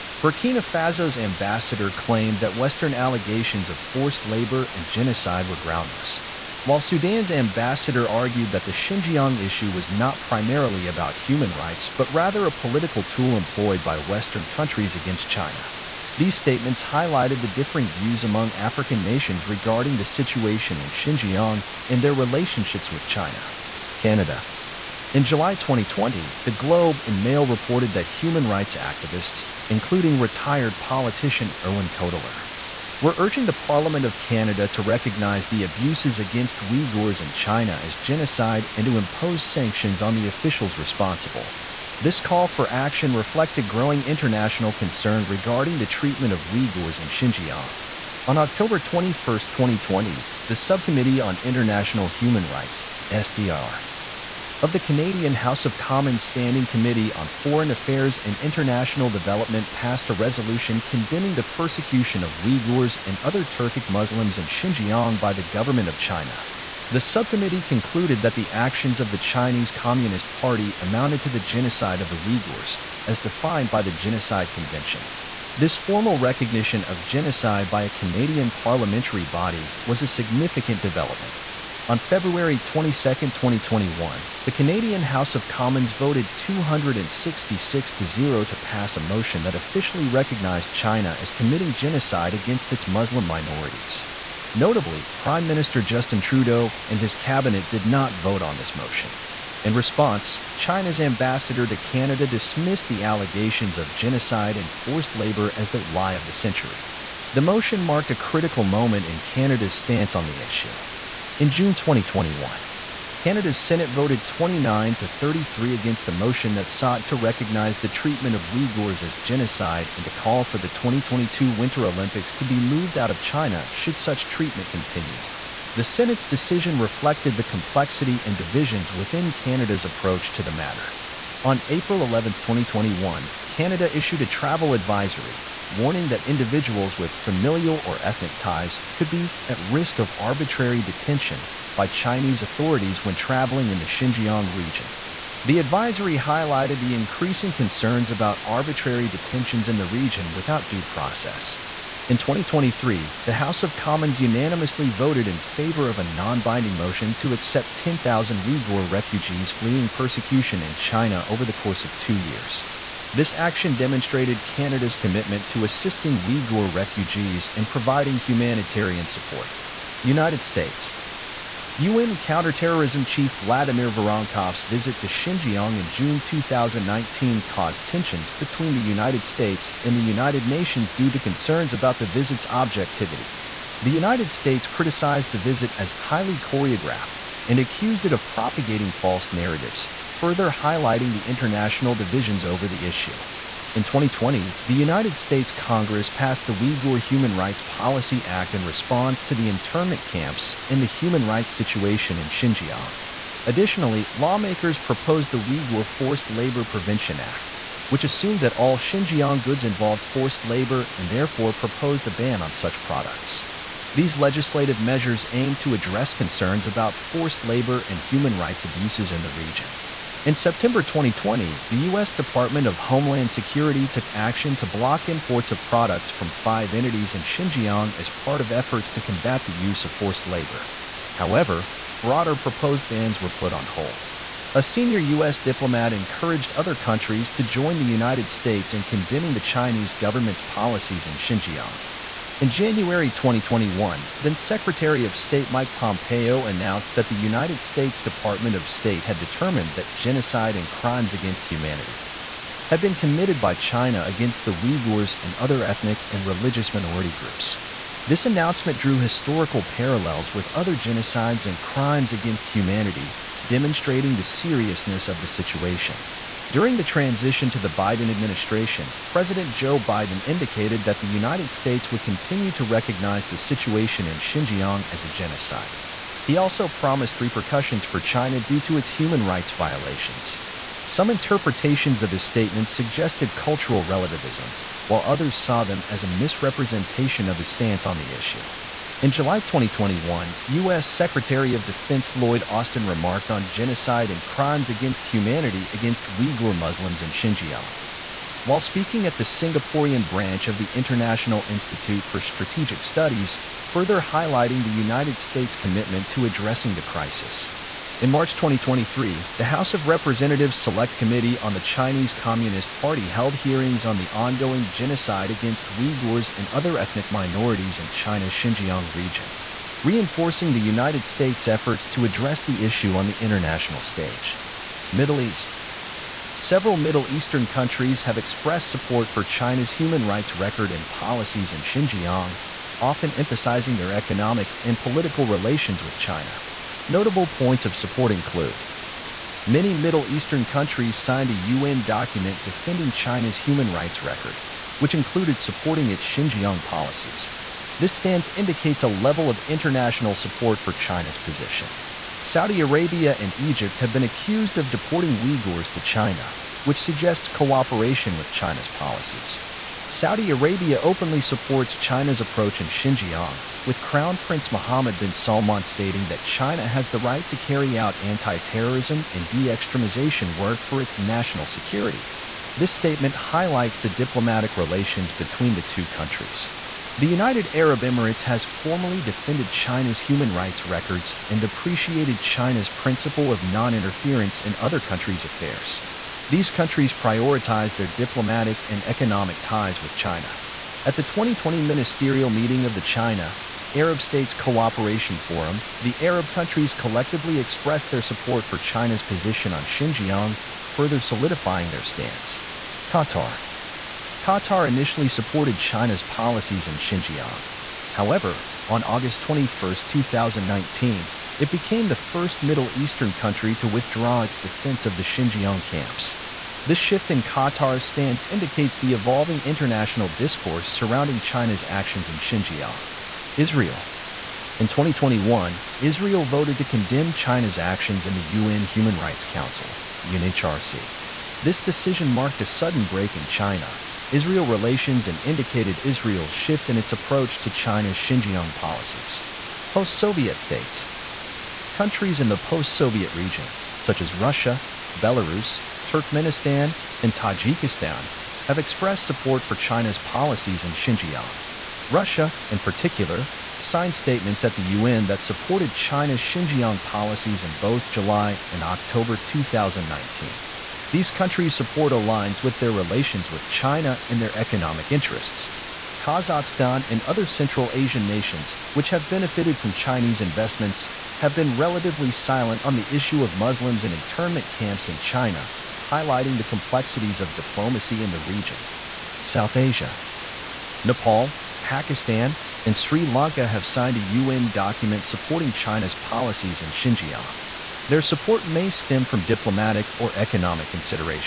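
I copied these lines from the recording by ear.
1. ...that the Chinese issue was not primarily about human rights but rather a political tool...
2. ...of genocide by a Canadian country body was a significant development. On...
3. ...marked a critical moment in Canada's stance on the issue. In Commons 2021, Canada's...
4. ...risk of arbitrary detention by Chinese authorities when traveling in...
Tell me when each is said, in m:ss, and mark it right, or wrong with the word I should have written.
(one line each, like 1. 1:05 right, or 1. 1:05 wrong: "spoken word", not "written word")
1. 0:08 wrong: "Xinjiang", not "Chinese"
2. 1:16 wrong: "parliamentary", not "country"
3. 1:47 wrong: "June", not "Commons"
4. 2:19 right.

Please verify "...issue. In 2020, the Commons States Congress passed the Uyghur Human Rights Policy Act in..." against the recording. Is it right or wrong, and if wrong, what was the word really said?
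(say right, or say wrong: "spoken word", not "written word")
wrong: "United", not "Commons".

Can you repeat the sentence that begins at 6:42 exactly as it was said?
Qatar Qatar initially supported China's policies in Xinjiang.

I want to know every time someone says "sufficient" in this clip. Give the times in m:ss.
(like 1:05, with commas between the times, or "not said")
not said.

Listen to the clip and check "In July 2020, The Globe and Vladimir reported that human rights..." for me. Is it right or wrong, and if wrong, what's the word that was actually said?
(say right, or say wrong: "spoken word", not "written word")
wrong: "Mail", not "Vladimir".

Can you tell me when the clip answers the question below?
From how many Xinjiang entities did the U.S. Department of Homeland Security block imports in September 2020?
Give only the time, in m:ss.
3:46.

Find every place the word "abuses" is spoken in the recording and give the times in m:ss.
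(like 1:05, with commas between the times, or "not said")
0:35, 3:38.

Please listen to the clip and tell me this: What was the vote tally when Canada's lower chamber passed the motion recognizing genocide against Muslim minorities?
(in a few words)
266 to 0.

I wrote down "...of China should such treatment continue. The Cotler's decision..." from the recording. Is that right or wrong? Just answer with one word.
wrong.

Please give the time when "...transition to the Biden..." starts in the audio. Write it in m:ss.
4:26.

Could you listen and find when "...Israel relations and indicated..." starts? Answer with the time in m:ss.
7:14.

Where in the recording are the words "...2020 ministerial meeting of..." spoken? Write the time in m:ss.
6:31.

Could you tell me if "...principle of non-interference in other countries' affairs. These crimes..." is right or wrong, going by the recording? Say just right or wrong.
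wrong.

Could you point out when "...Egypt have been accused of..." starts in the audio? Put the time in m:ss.
5:53.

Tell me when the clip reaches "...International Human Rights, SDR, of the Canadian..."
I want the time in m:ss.
0:51.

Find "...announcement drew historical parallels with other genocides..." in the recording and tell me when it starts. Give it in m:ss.
4:18.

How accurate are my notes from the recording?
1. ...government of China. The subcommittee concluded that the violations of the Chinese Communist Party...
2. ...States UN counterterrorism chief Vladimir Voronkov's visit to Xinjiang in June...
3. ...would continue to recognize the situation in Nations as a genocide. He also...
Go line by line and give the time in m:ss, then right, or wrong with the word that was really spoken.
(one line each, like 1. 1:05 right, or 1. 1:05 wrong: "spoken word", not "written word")
1. 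1:05 wrong: "actions", not "violations"
2. 2:50 right
3. 4:31 wrong: "Xinjiang", not "Nations".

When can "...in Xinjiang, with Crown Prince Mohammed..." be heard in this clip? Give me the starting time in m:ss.
6:02.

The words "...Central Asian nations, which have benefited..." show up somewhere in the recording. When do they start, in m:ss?
7:47.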